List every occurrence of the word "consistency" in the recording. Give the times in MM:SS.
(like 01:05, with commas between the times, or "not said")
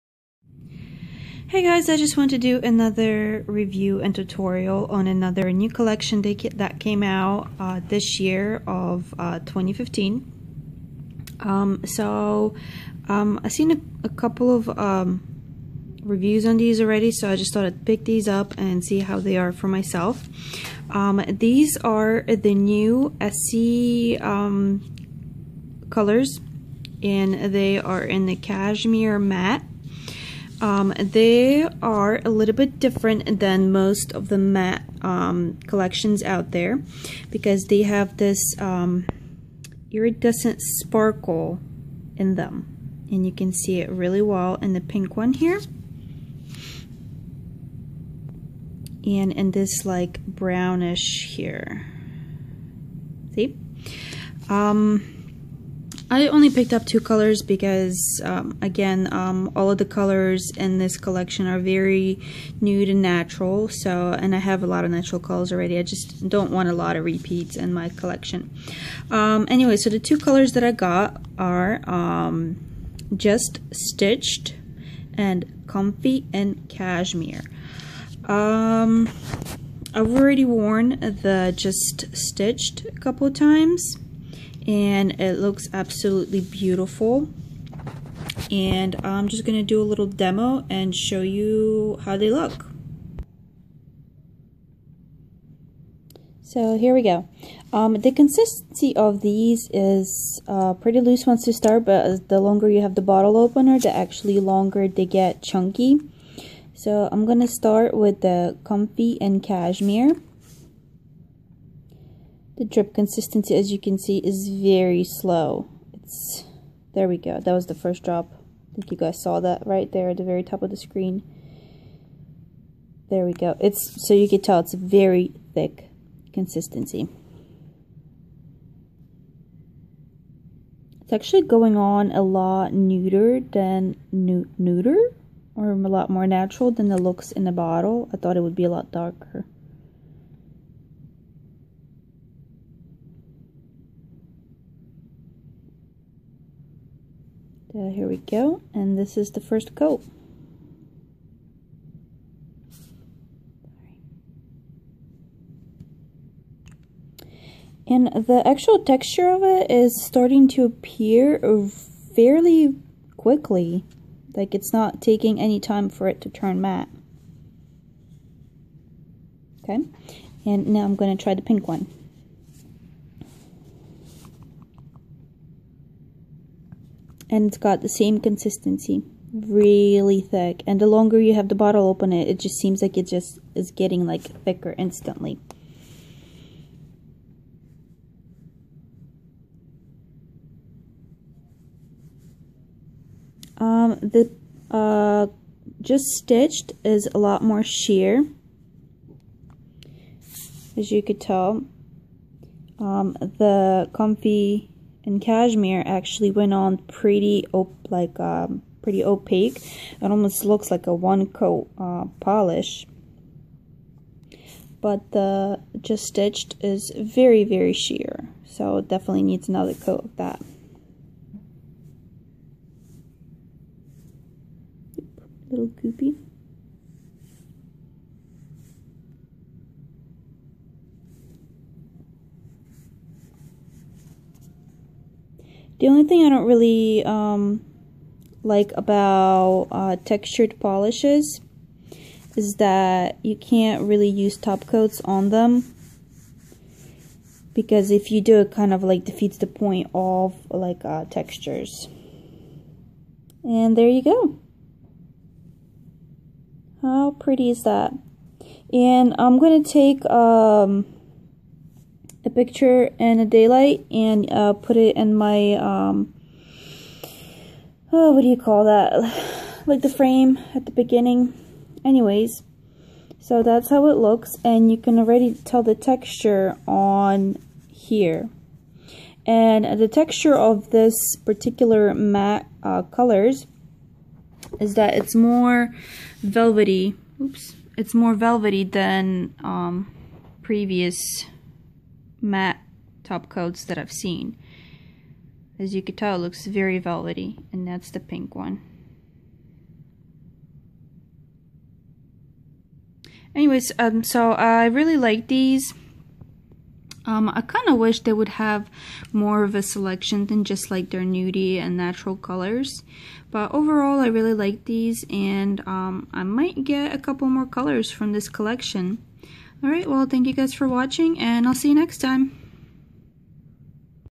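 01:38, 01:52, 02:06, 02:58.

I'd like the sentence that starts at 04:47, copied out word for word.
Oops, it's more velvety than um, previous matte top coats that I've seen.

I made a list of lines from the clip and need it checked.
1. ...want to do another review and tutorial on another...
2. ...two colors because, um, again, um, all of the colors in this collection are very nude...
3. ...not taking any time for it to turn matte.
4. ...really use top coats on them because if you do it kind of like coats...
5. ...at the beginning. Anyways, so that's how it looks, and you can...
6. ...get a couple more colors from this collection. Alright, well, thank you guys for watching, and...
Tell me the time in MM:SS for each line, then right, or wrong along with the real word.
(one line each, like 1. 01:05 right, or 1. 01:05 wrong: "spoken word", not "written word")
1. 00:02 right
2. 00:56 right
3. 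02:44 right
4. 04:03 wrong: "defeats", not "coats"
5. 04:30 right
6. 05:16 right.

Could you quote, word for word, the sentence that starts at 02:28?
And this is the first coat.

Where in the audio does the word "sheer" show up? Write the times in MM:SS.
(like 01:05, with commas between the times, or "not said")
03:17, 03:37.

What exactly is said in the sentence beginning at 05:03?
Anyways, um, so I really like these.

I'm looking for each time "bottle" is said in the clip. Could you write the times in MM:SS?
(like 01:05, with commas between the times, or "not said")
01:43, 02:17, 03:01.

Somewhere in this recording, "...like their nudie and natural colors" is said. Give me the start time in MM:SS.
05:10.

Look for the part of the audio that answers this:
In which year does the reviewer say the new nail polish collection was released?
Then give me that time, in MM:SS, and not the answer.
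00:09.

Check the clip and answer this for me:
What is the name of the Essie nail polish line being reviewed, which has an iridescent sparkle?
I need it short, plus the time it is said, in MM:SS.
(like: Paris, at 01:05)
Cashmere matte, at 00:28.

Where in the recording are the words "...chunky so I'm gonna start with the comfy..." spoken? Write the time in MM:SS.
01:45.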